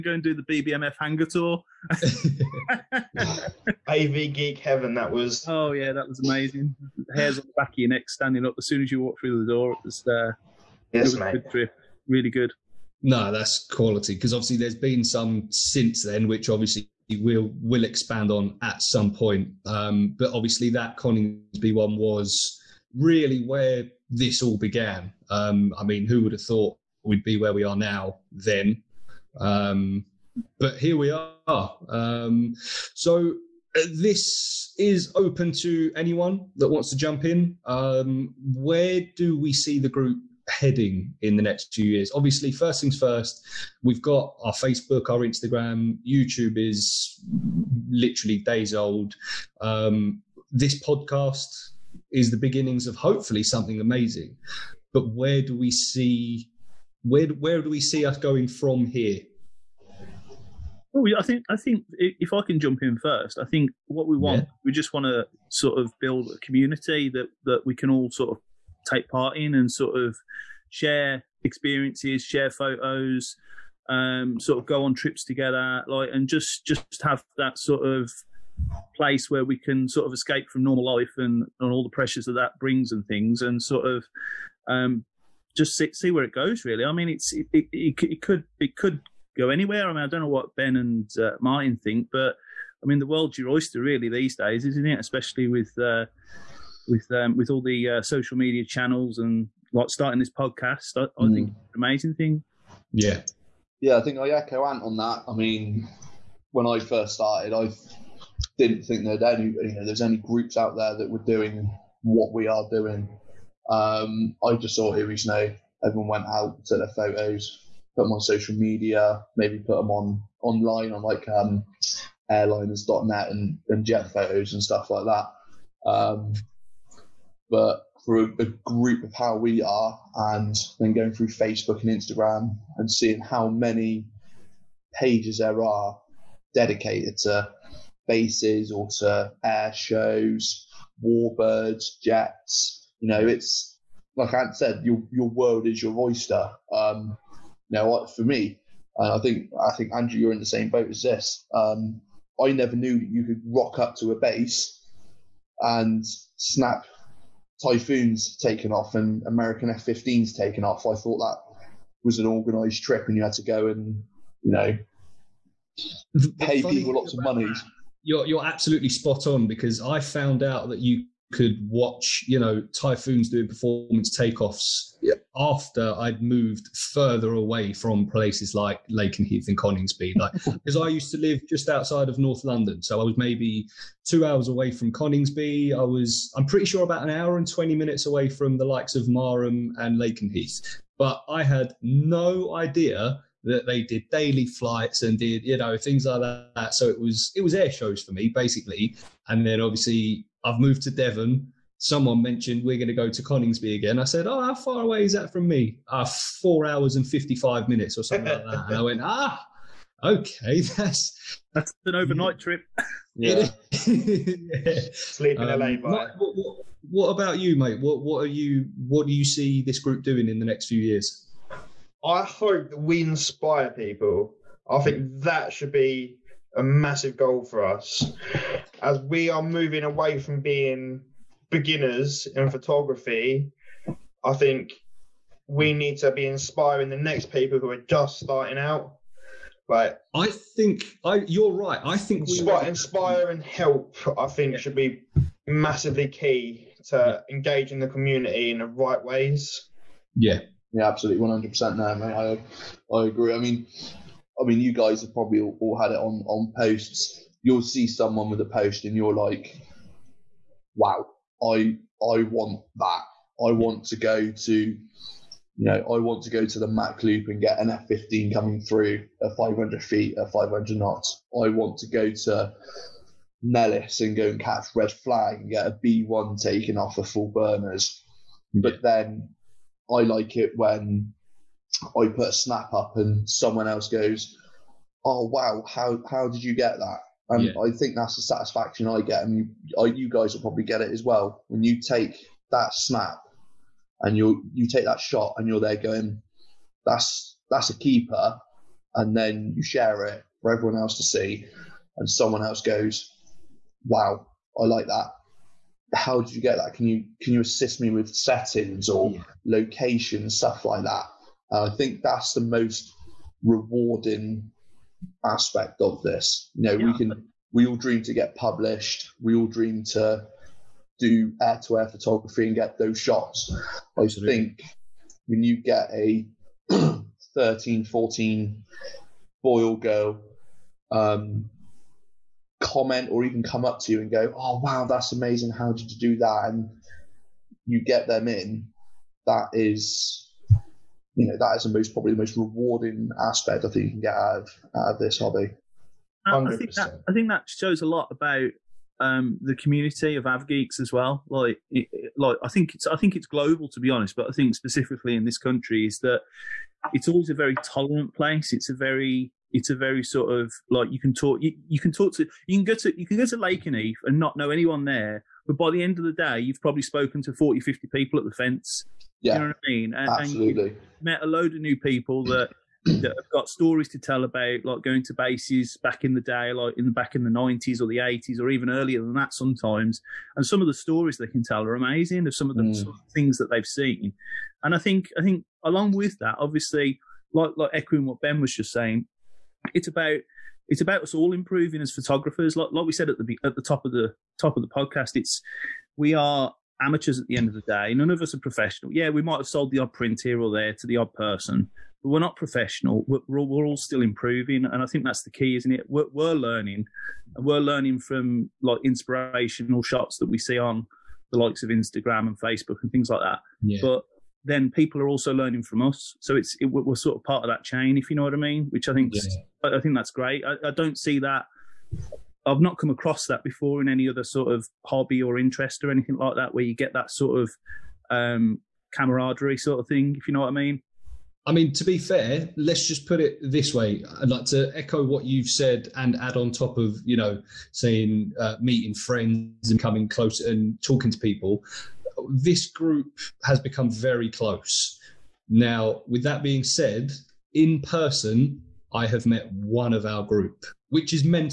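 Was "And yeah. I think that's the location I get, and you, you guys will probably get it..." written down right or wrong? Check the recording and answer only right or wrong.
wrong.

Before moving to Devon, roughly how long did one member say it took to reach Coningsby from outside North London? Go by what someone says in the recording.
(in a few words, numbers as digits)
2 hours.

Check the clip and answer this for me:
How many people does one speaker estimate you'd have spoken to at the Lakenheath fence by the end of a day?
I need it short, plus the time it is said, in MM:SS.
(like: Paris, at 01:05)
40 to 50, at 06:07.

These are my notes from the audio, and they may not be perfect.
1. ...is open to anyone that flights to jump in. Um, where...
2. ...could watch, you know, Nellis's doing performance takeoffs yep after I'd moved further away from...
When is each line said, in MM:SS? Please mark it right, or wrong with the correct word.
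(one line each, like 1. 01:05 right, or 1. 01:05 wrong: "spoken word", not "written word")
1. 00:34 wrong: "wants", not "flights"
2. 02:51 wrong: "Typhoon", not "Nellis".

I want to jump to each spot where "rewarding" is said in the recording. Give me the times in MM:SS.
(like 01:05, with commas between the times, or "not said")
05:13, 05:42.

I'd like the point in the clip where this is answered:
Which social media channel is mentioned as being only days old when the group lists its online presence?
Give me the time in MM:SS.
00:46.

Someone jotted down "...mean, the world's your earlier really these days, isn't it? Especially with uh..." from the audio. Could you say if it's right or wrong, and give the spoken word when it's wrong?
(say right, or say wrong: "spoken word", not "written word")
wrong: "oyster", not "earlier".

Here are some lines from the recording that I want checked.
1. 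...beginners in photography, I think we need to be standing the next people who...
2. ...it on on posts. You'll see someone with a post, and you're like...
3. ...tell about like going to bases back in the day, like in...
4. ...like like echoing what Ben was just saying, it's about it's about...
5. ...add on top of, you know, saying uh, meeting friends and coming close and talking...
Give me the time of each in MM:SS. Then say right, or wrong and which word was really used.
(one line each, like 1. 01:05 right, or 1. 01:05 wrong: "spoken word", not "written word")
1. 03:51 wrong: "inspiring", not "standing"
2. 04:15 right
3. 06:13 right
4. 06:27 right
5. 07:16 right.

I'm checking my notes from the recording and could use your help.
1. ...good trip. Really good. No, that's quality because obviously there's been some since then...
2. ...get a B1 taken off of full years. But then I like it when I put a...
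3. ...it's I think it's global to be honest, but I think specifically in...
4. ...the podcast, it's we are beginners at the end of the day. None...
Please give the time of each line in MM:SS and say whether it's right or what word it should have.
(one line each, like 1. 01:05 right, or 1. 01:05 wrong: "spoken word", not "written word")
1. 00:11 right
2. 04:35 wrong: "burners", not "years"
3. 05:52 right
4. 06:34 wrong: "amateurs", not "beginners".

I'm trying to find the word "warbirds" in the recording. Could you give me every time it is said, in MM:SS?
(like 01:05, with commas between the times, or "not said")
02:21.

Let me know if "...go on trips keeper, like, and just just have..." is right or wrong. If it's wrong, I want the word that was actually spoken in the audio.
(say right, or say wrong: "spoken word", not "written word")
wrong: "together", not "keeper".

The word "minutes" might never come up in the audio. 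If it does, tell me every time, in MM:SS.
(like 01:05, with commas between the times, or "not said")
03:07, 03:27.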